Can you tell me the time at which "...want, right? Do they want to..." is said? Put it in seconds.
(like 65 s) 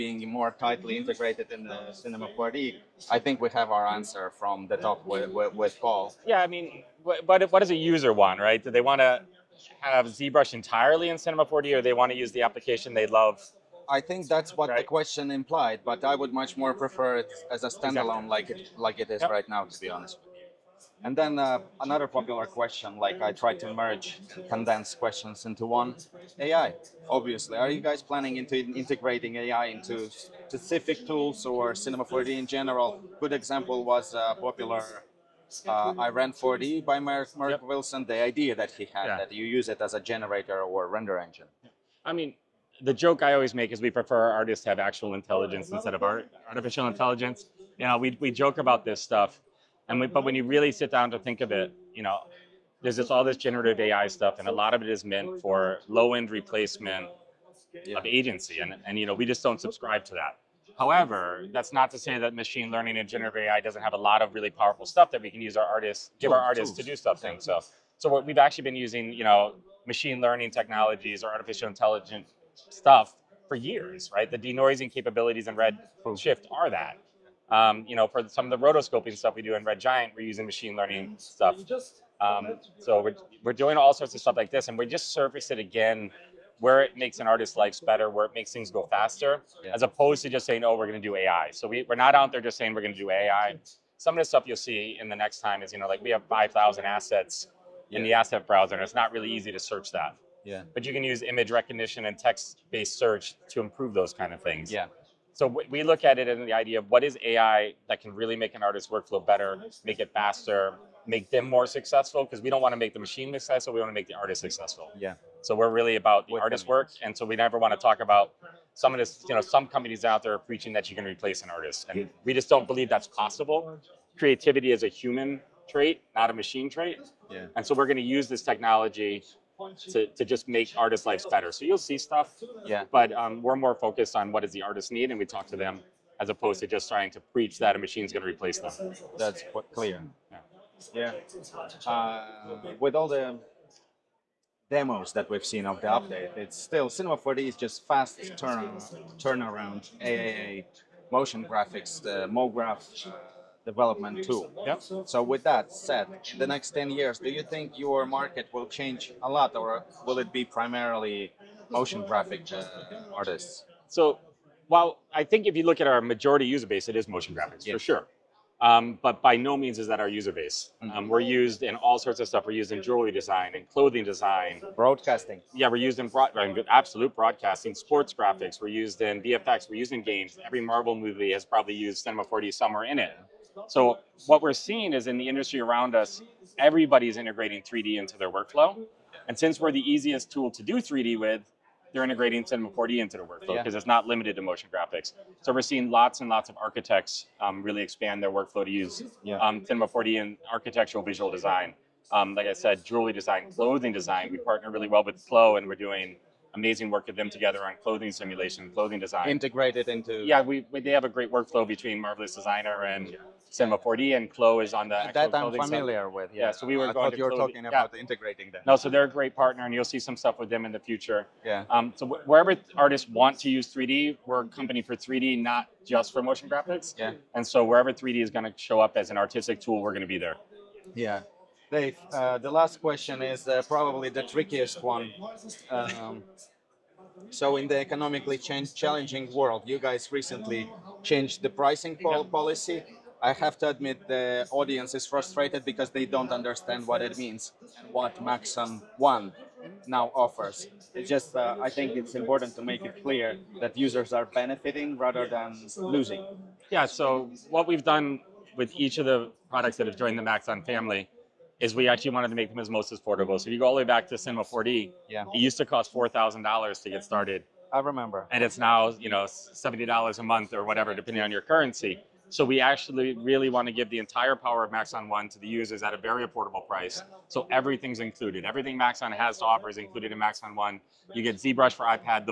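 8 s.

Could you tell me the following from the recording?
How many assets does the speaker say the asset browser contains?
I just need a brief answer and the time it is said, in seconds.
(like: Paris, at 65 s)
5,000, at 96 s.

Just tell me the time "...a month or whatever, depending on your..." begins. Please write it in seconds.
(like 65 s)
270 s.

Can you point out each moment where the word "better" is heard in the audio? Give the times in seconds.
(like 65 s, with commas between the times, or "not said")
87 s, 109 s, 131 s.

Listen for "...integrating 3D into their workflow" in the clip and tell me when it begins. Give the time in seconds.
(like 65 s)
187 s.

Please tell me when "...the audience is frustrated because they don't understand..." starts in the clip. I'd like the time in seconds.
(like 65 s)
244 s.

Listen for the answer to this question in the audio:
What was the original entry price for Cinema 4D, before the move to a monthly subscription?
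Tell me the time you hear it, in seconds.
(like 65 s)
265 s.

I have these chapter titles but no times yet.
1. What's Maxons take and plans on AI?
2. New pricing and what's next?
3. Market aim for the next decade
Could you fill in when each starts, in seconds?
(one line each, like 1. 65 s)
1. 22 s
2. 230 s
3. 142 s.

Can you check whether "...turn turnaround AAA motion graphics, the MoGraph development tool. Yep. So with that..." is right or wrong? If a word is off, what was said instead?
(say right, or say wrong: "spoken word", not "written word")
right.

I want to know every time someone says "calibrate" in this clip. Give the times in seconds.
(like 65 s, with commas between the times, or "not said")
not said.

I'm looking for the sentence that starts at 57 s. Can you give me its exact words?
of agency, and, and you know, we just don't subscribe to that.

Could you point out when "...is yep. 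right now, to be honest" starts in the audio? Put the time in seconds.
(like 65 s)
19 s.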